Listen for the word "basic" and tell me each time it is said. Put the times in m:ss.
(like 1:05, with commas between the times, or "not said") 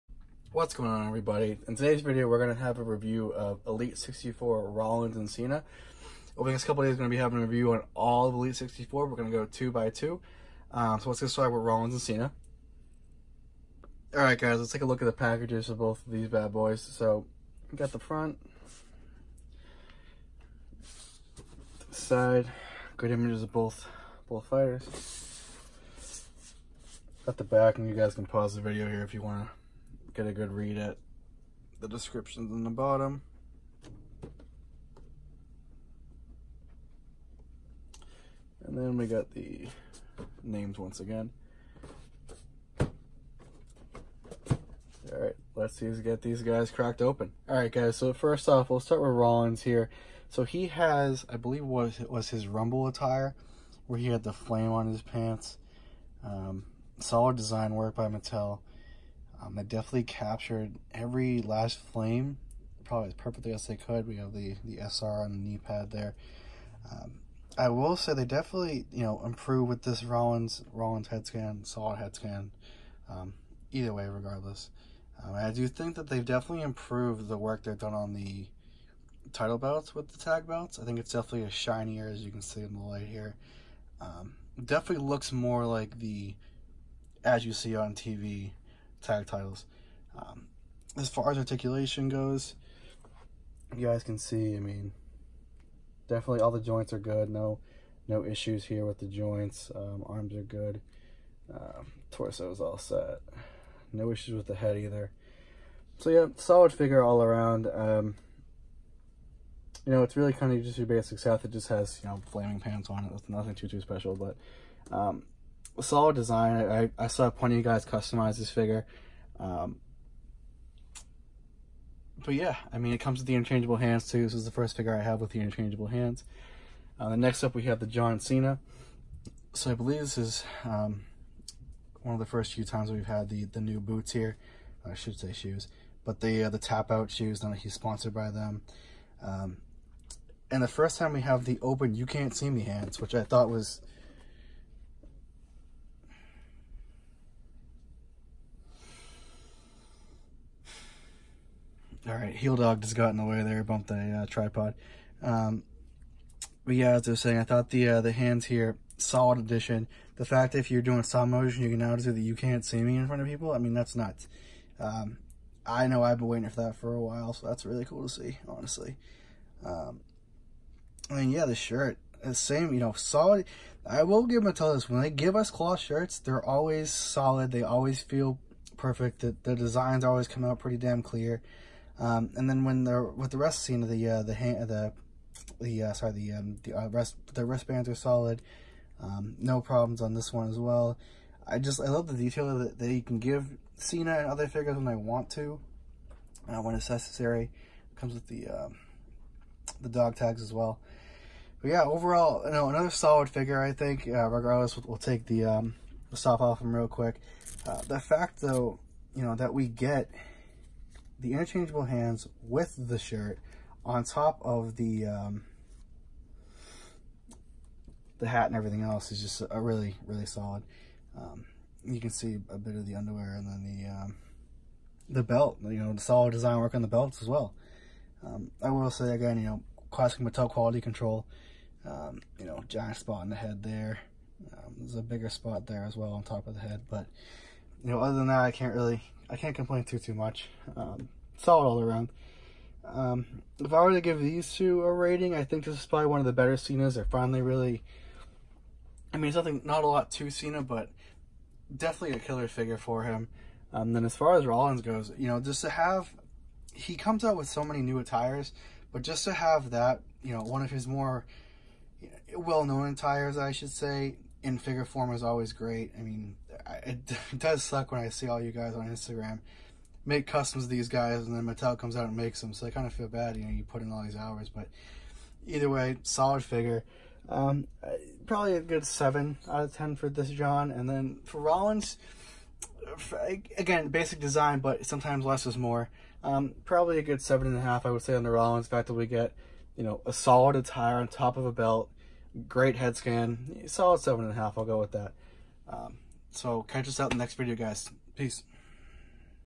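1:50, 4:43.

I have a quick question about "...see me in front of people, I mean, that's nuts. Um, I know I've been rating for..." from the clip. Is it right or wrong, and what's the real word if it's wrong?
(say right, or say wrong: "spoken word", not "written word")
wrong: "waiting", not "rating".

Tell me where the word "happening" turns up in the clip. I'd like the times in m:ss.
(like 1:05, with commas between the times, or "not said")
not said.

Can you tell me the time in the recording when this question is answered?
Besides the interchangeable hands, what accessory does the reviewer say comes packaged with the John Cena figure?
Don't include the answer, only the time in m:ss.
3:19.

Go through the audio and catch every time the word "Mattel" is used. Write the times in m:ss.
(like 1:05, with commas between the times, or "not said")
0:58, 3:50, 4:31.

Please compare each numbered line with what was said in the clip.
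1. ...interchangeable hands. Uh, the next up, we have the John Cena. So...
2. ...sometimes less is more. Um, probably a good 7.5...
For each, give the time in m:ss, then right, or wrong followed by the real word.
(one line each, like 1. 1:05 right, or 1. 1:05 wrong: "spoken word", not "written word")
1. 2:05 right
2. 4:44 right.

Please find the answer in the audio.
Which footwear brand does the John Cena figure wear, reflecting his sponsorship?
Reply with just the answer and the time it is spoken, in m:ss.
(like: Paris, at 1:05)
Tap out, at 2:16.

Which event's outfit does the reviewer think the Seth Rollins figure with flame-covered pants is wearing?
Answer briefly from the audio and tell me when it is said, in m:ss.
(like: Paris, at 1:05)
Rumble, at 0:52.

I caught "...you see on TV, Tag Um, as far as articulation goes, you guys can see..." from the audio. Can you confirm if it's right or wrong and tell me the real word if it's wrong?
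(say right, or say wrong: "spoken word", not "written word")
right.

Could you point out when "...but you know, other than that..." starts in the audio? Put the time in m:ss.
3:56.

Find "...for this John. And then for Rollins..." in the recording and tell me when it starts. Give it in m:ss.
4:39.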